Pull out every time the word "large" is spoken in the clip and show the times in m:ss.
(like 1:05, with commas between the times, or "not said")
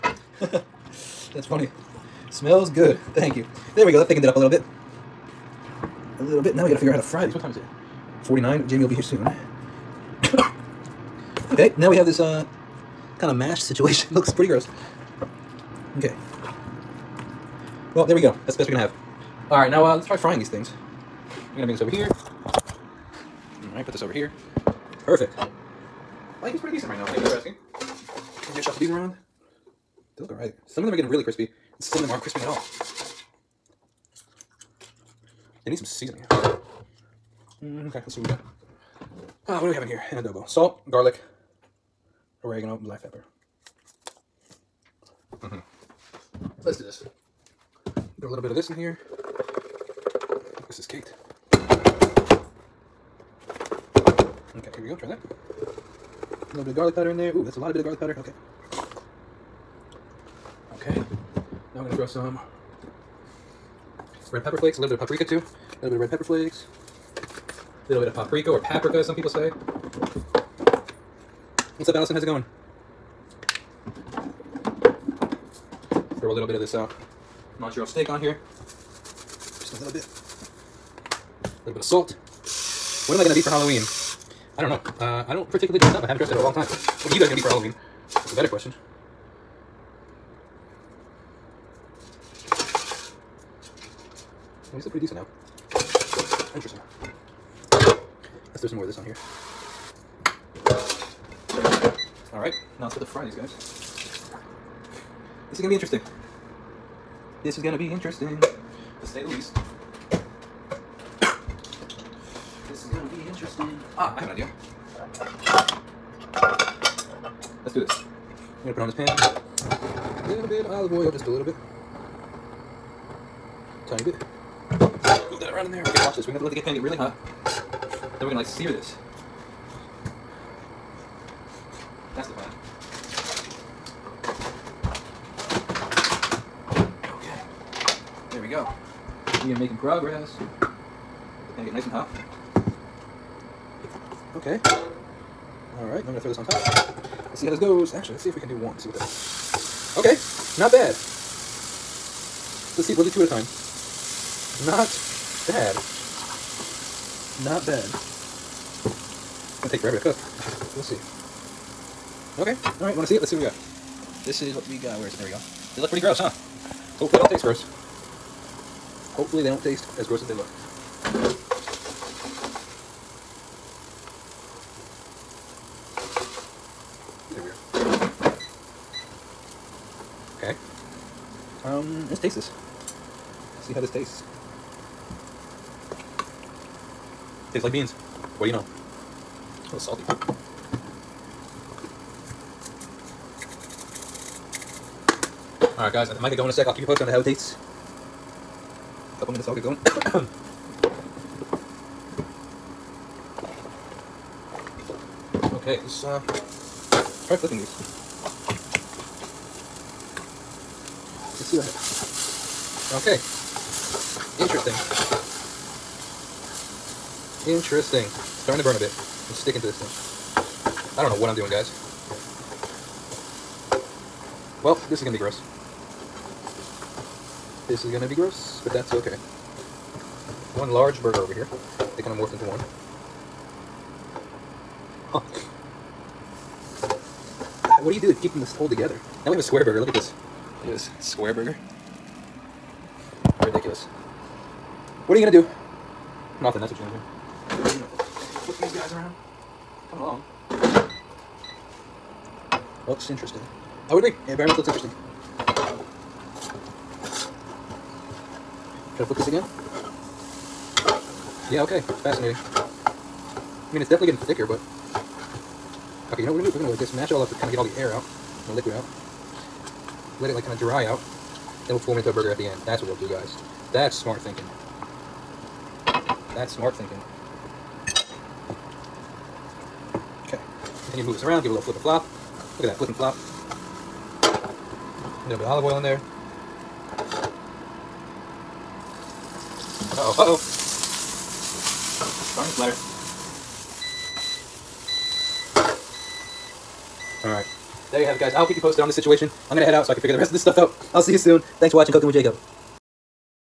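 3:50.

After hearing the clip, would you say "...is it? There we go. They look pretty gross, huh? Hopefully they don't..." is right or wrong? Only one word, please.
right.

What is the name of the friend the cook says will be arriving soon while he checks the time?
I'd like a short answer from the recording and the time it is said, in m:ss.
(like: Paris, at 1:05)
Jamie, at 0:08.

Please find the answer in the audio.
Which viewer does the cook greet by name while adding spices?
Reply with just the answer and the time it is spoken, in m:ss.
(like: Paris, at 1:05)
Allison, at 1:11.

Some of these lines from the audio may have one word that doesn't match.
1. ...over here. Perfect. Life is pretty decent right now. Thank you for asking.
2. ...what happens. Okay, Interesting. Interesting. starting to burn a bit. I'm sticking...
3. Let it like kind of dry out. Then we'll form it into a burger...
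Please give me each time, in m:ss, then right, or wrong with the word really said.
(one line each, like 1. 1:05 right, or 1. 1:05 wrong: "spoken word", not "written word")
1. 0:24 right
2. 3:31 right
3. 4:30 right.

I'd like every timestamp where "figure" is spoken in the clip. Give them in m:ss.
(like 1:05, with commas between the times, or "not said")
0:06, 5:00.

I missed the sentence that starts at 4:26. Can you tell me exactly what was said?
Okay, you know what we're gonna do?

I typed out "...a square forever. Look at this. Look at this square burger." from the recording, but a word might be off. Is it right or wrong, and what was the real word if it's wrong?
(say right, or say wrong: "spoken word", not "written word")
wrong: "burger", not "forever".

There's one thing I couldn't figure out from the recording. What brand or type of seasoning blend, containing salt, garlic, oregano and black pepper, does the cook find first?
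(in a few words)
Adobo.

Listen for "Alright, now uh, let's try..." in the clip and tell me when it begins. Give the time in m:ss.
0:19.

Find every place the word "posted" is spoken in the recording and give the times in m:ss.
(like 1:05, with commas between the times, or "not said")
3:16, 4:58.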